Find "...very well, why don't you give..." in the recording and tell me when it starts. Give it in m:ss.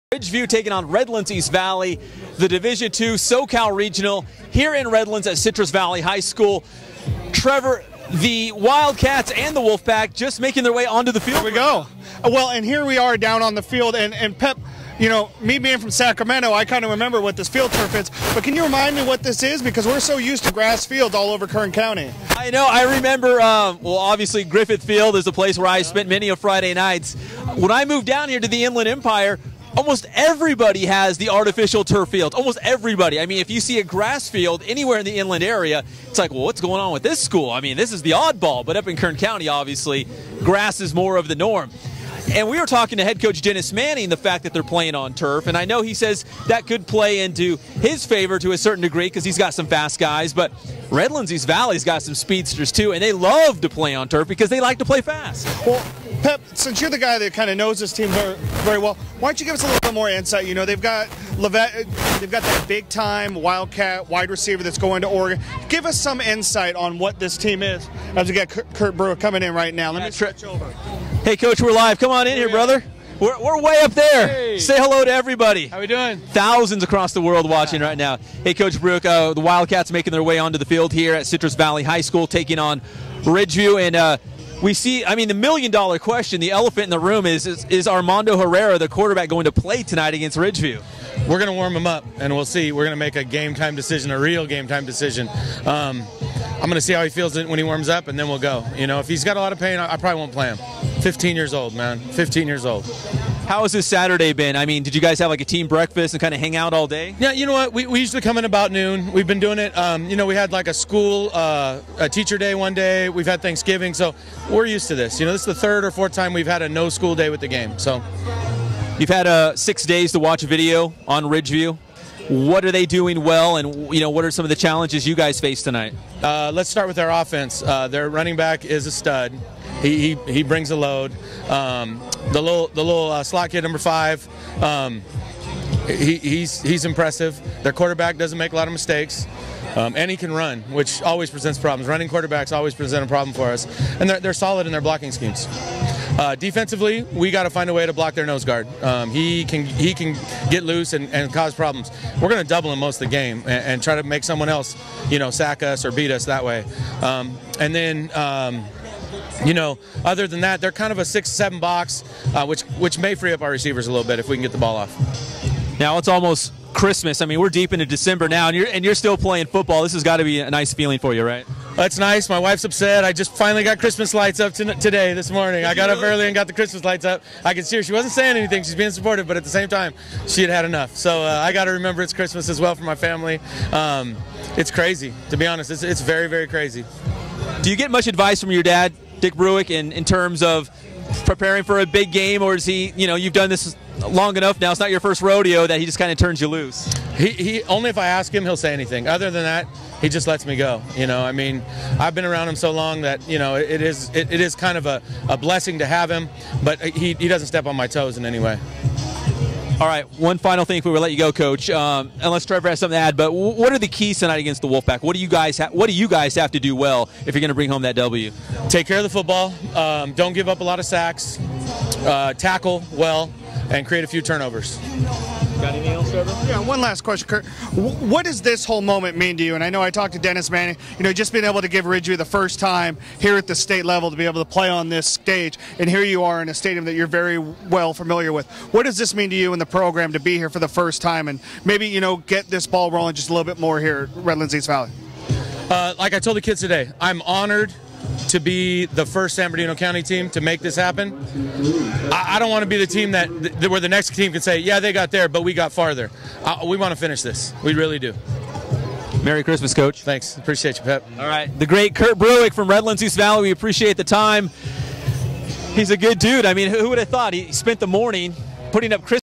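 0:58.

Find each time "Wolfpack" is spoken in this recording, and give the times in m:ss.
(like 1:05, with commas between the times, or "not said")
0:09, 3:34.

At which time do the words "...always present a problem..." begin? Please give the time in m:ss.
2:22.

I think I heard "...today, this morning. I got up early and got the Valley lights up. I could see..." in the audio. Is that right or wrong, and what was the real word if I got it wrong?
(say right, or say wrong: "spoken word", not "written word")
wrong: "Christmas", not "Valley".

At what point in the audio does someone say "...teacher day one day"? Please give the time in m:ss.
1:52.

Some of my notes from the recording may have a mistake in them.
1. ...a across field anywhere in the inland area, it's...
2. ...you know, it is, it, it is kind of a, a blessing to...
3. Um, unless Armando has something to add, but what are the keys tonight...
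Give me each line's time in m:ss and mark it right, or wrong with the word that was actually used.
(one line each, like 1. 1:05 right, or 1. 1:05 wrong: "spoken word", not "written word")
1. 0:33 wrong: "grass", not "across"
2. 3:23 right
3. 3:31 wrong: "Trevor", not "Armando".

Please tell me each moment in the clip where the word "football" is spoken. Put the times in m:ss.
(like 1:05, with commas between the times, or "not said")
2:49, 3:39.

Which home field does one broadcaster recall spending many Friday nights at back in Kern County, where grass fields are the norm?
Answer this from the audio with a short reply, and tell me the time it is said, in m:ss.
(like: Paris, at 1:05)
Griffith Field, at 0:24.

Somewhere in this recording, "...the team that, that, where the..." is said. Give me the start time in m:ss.
4:12.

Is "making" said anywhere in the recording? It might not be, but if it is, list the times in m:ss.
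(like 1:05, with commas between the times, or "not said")
0:10, 1:19.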